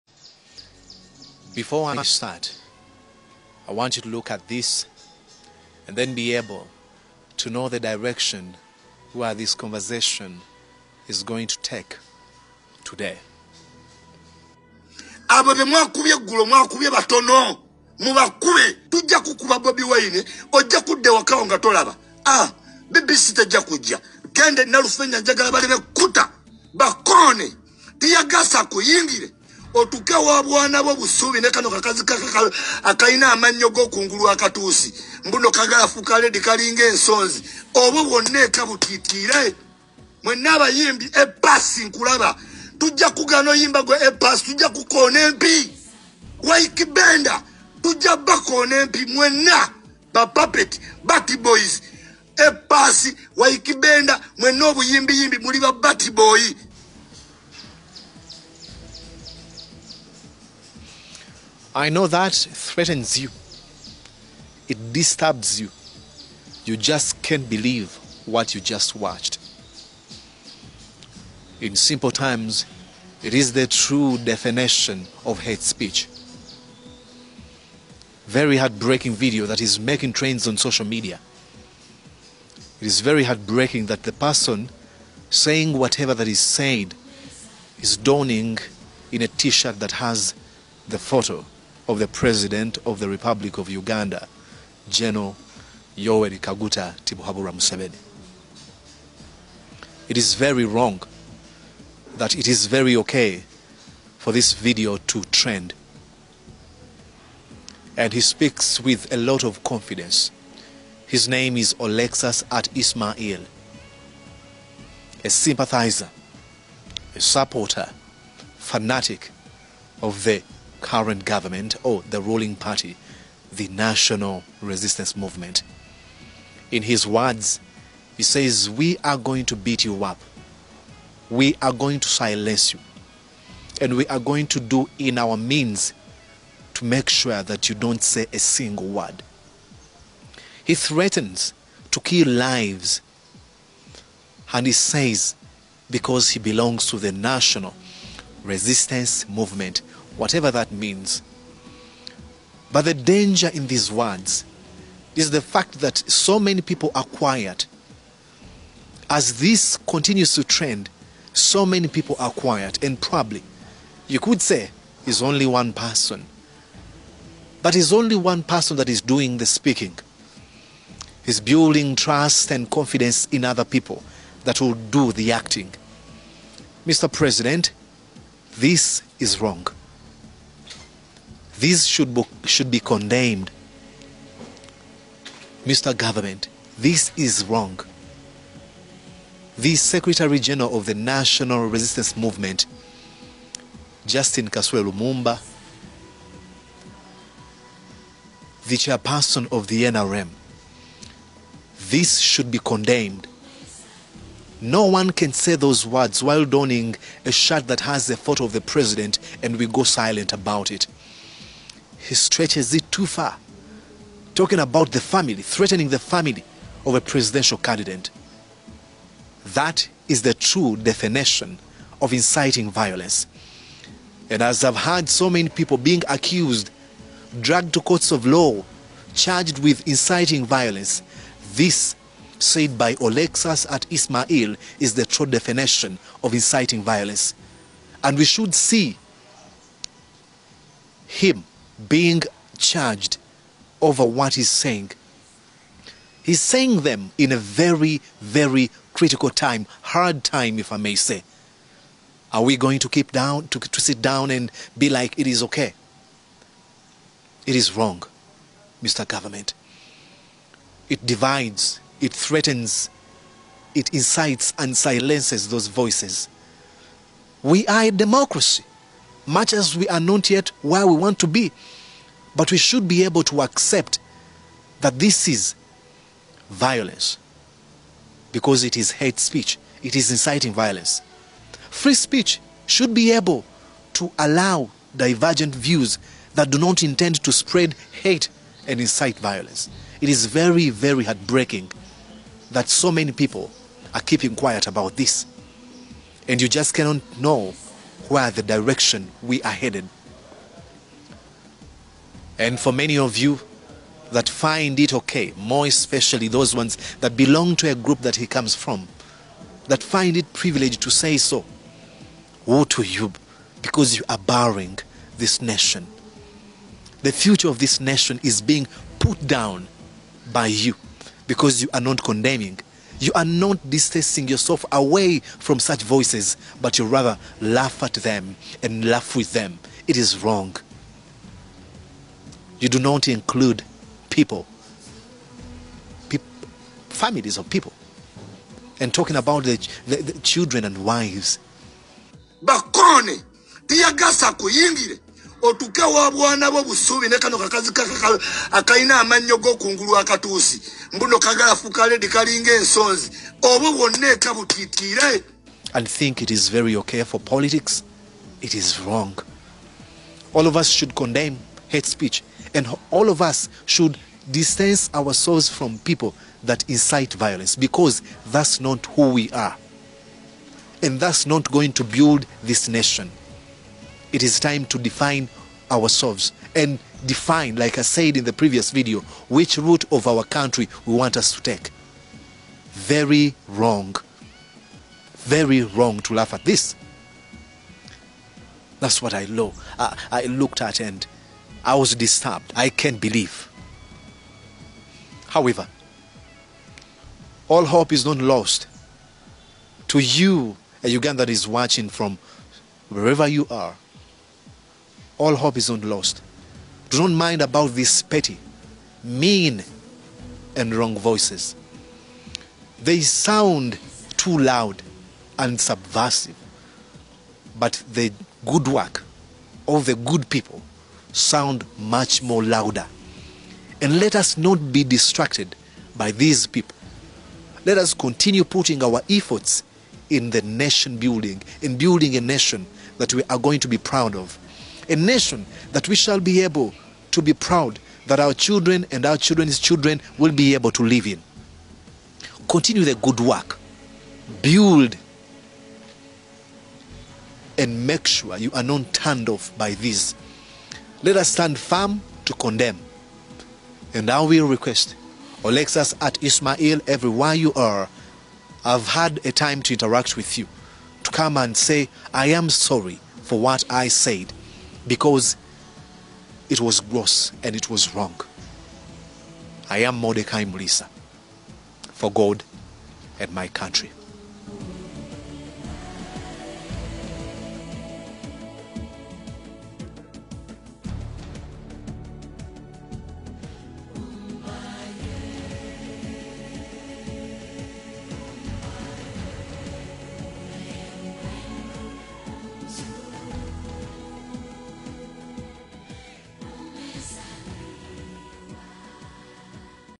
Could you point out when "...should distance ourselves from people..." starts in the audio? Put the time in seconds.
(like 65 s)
363 s.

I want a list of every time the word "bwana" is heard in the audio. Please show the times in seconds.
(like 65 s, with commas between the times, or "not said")
30 s, 346 s.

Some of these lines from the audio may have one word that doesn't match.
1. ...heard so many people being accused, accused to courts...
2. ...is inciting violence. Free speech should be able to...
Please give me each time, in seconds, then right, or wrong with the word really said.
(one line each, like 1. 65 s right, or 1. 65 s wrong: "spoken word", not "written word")
1. 224 s wrong: "dragged", not "accused"
2. 279 s right.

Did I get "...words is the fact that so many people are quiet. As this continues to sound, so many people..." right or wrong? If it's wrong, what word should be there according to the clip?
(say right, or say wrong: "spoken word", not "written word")
wrong: "trend", not "sound".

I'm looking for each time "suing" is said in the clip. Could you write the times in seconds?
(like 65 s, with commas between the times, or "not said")
not said.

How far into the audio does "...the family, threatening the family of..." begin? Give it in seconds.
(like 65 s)
214 s.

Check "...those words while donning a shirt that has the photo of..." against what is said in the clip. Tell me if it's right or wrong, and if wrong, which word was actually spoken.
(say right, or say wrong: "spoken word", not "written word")
right.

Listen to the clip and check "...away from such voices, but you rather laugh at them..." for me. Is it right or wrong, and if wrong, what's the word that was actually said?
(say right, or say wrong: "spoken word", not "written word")
right.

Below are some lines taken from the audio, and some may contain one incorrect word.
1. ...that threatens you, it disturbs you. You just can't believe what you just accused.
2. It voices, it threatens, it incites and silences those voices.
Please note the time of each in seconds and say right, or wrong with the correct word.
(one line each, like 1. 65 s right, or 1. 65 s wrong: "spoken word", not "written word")
1. 62 s wrong: "watched", not "accused"
2. 260 s wrong: "divides", not "voices".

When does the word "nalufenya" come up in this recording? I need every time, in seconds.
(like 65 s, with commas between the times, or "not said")
24 s.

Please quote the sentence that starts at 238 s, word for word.
And we should see him being charged over what he's saying.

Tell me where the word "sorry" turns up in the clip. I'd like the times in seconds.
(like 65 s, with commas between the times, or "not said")
462 s.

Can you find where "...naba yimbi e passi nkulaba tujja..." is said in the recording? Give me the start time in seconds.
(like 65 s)
40 s.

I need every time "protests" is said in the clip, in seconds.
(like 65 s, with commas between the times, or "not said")
not said.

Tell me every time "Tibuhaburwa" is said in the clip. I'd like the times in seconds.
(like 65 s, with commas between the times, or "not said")
97 s.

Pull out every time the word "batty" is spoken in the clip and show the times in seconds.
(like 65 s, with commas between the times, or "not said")
51 s, 55 s.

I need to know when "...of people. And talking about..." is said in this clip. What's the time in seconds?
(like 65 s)
337 s.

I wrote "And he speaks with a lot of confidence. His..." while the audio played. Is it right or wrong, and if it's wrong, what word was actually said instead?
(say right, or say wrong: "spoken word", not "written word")
right.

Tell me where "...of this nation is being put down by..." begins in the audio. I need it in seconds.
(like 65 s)
317 s.